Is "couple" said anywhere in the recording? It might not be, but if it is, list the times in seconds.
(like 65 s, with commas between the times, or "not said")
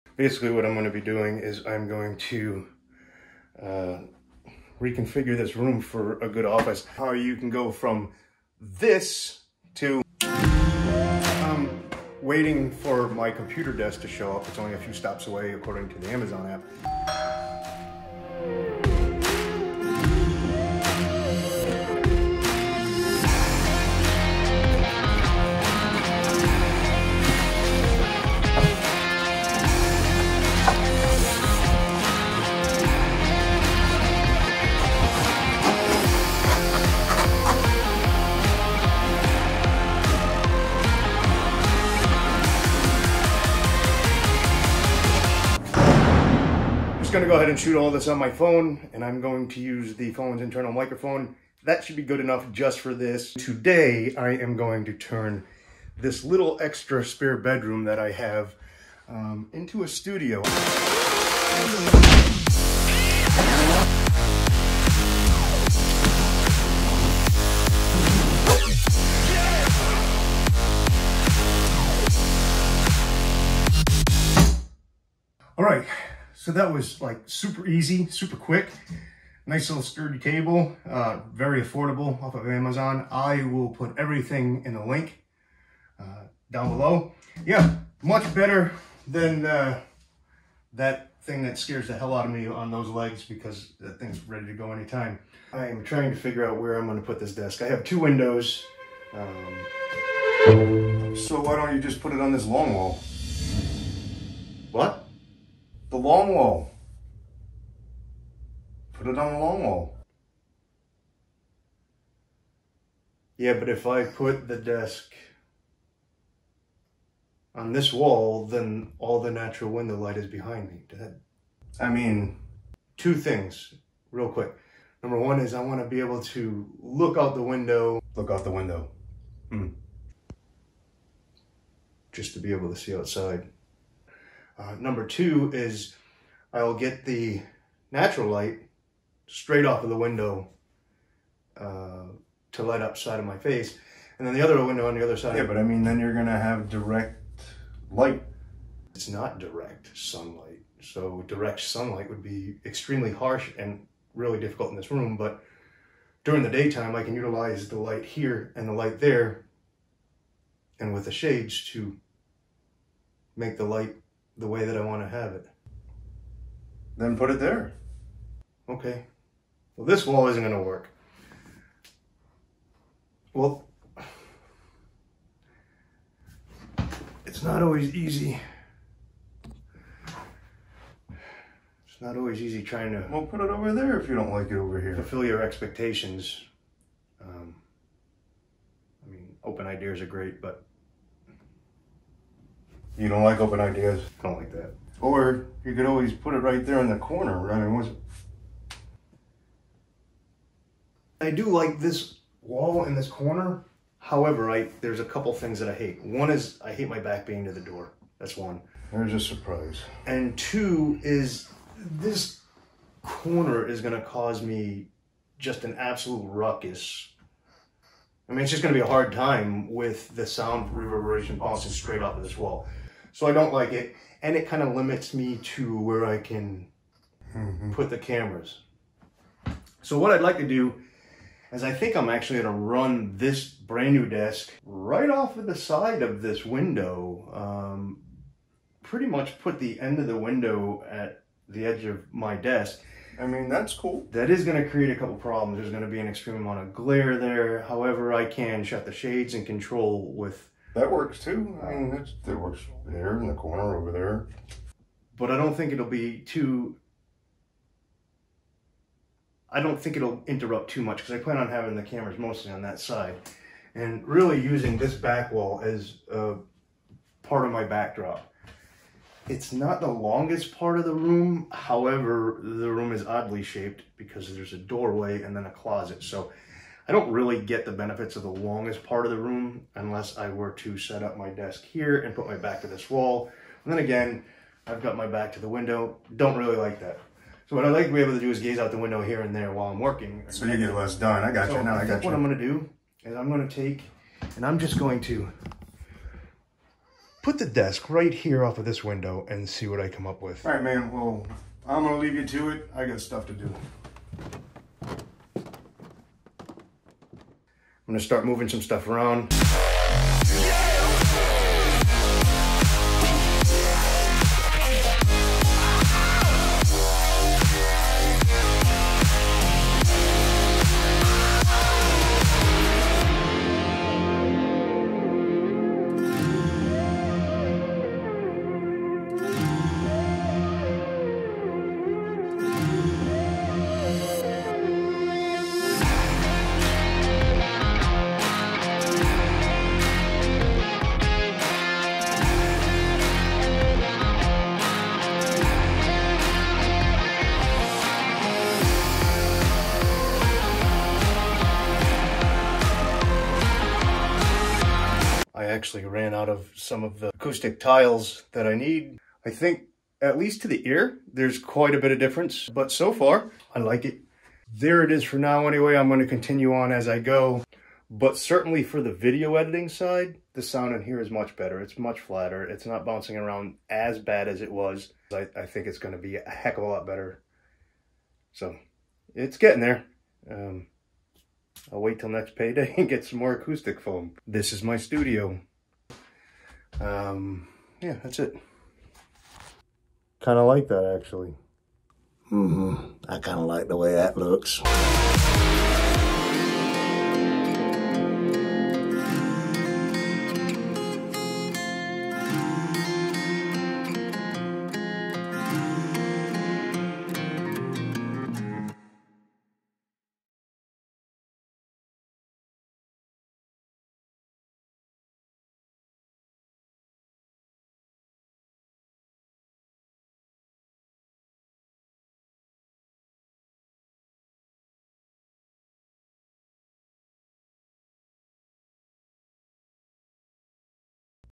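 205 s, 244 s.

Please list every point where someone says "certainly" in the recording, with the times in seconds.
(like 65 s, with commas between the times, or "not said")
368 s.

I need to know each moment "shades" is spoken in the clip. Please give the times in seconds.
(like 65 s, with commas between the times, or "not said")
161 s, 248 s.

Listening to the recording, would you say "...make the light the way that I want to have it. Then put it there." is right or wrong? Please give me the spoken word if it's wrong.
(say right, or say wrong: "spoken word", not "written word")
right.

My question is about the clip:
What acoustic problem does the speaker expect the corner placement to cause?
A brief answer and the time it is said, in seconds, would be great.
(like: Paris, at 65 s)
sound reverberation, at 220 s.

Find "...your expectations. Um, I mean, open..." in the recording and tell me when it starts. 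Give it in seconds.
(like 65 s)
185 s.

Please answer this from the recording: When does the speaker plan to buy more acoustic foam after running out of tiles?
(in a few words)
next payday.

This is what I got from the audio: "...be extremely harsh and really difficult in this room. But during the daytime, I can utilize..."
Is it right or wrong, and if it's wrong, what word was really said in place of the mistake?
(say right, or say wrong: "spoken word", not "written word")
right.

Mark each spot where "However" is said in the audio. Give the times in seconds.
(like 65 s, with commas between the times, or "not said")
203 s, 247 s, 271 s.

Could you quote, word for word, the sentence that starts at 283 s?
And then again, I've got my back to the window.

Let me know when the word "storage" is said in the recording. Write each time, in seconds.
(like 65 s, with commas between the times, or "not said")
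not said.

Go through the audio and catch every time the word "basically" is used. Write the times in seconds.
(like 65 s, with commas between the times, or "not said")
0 s.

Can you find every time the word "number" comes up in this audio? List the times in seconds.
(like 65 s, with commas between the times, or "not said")
125 s, 134 s.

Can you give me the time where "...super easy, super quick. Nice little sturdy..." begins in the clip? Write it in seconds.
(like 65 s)
77 s.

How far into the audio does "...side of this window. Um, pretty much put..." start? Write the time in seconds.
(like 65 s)
235 s.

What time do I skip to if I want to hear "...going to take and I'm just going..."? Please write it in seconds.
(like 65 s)
293 s.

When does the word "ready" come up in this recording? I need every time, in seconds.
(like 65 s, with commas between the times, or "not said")
94 s.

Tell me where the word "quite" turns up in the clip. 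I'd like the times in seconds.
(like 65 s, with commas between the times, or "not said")
361 s.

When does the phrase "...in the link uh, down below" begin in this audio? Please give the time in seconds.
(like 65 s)
84 s.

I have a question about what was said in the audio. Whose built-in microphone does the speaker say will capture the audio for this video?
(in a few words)
phone's internal microphone.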